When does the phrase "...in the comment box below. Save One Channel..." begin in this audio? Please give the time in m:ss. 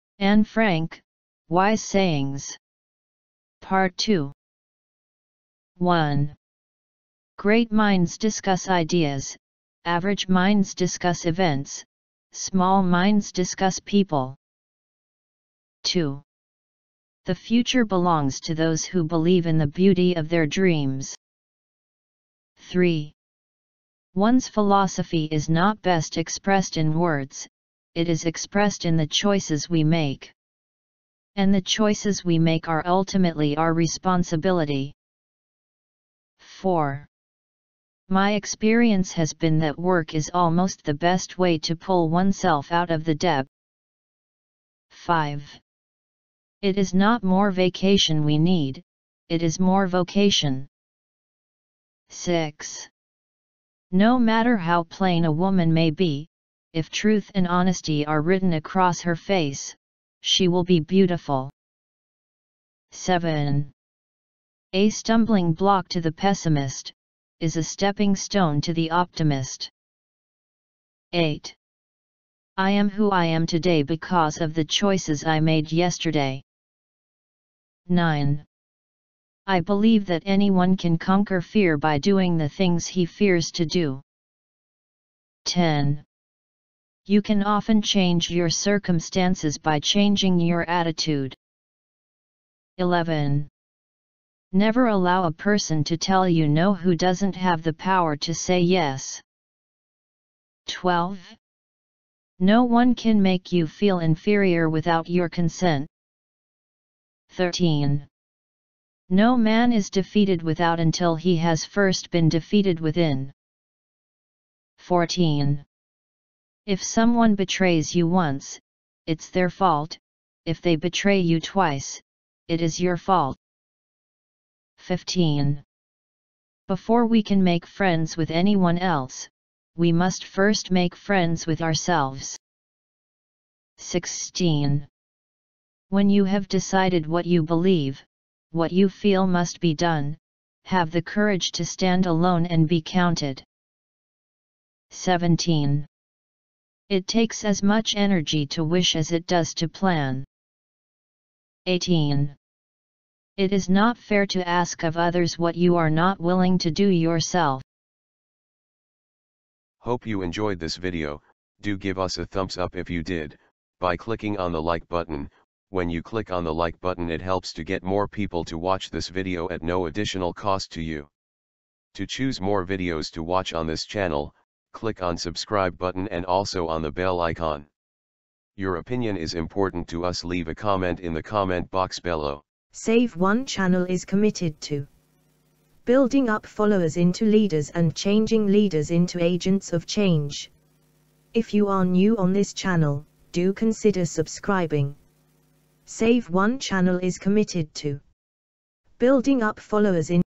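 3:00.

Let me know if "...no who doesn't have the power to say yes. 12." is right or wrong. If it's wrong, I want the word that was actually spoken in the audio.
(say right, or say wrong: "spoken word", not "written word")
right.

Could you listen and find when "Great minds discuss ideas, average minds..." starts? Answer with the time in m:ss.
0:07.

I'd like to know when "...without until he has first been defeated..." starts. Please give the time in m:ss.
1:50.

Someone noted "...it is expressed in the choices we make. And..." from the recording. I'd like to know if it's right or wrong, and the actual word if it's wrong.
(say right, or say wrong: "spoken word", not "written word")
right.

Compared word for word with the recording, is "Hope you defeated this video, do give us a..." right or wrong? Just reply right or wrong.
wrong.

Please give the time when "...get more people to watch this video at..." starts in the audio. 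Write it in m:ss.
2:47.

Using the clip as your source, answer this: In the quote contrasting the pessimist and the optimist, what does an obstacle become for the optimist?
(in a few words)
stepping stone.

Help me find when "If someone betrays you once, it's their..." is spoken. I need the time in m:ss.
1:56.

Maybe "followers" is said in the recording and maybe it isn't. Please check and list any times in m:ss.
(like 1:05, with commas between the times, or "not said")
3:06, 3:19.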